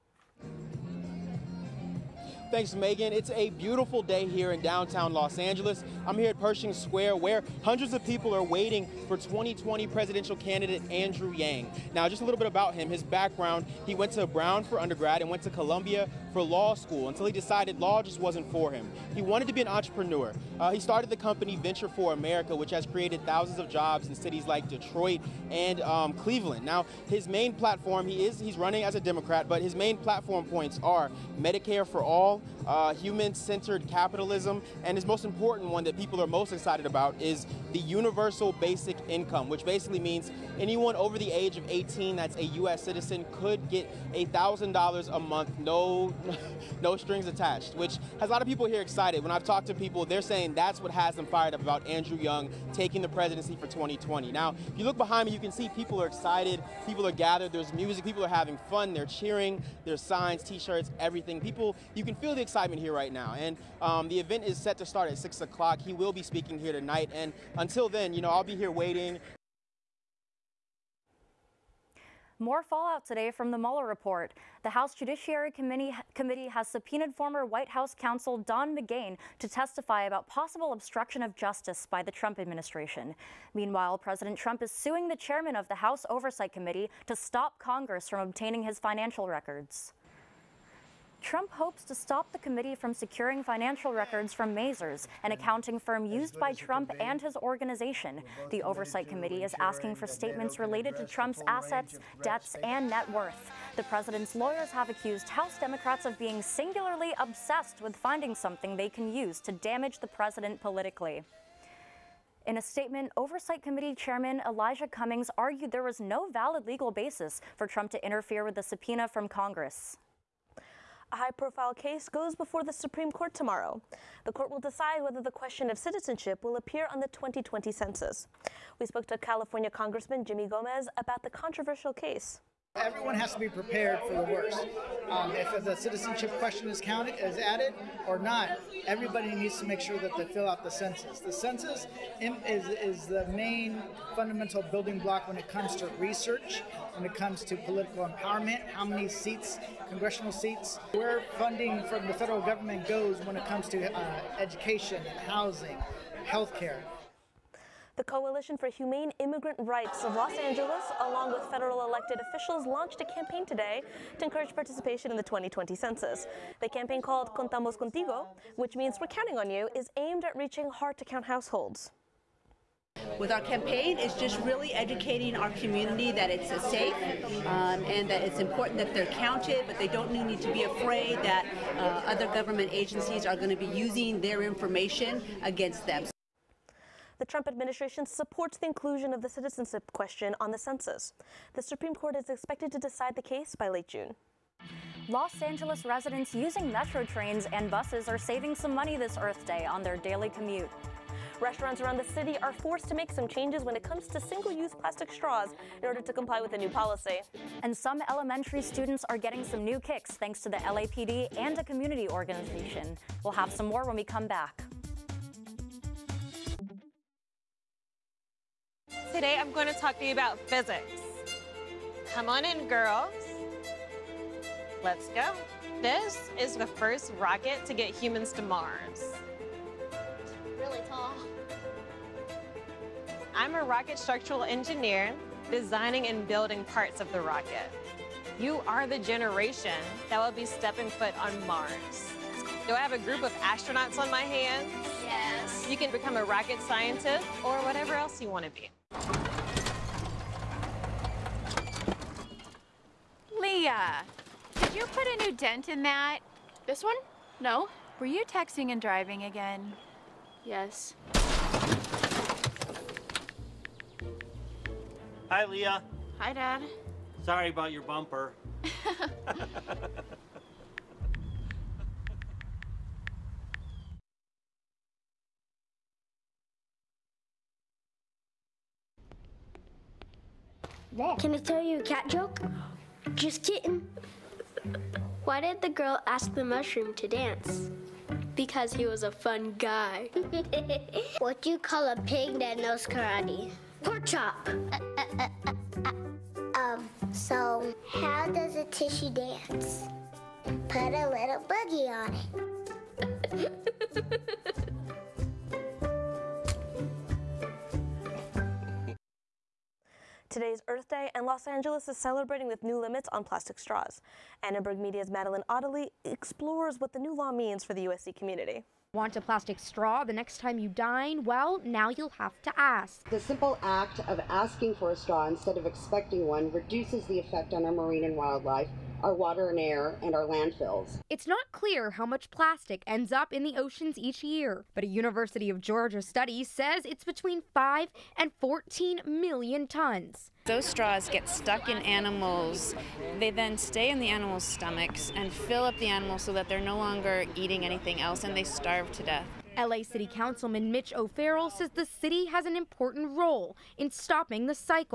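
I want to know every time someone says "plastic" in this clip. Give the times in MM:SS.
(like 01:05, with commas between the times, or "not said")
03:24, 05:13, 05:19, 05:32.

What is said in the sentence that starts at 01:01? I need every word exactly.
People, you can feel feel the excitement here right now.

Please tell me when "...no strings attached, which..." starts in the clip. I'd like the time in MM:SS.
00:46.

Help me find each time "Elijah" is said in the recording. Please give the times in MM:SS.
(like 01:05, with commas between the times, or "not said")
01:54.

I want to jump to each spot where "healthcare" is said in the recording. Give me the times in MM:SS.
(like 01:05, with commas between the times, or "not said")
02:36.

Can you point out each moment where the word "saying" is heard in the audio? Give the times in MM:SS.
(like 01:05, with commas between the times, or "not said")
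00:50.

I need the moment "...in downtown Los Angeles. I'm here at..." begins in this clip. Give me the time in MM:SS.
00:04.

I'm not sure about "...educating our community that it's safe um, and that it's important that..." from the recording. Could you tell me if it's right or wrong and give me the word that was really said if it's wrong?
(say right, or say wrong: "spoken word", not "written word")
right.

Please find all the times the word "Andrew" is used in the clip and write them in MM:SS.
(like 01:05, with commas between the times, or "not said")
00:10, 00:51.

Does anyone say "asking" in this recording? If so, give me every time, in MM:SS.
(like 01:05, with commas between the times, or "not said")
01:39, 05:24.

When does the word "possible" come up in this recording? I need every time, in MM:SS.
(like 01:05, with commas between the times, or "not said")
01:20.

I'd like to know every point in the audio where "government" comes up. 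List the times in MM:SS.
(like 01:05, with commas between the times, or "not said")
02:32, 03:02.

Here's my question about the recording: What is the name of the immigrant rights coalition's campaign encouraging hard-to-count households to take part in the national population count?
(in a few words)
Contamos Contigo.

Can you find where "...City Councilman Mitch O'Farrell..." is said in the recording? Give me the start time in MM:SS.
05:49.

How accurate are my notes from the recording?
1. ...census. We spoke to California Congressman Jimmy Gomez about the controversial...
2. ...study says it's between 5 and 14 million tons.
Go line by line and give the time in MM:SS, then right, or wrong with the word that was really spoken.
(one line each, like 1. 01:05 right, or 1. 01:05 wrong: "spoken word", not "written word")
1. 02:07 right
2. 05:36 right.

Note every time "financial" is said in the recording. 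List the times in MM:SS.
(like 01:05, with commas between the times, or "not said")
01:28, 01:33.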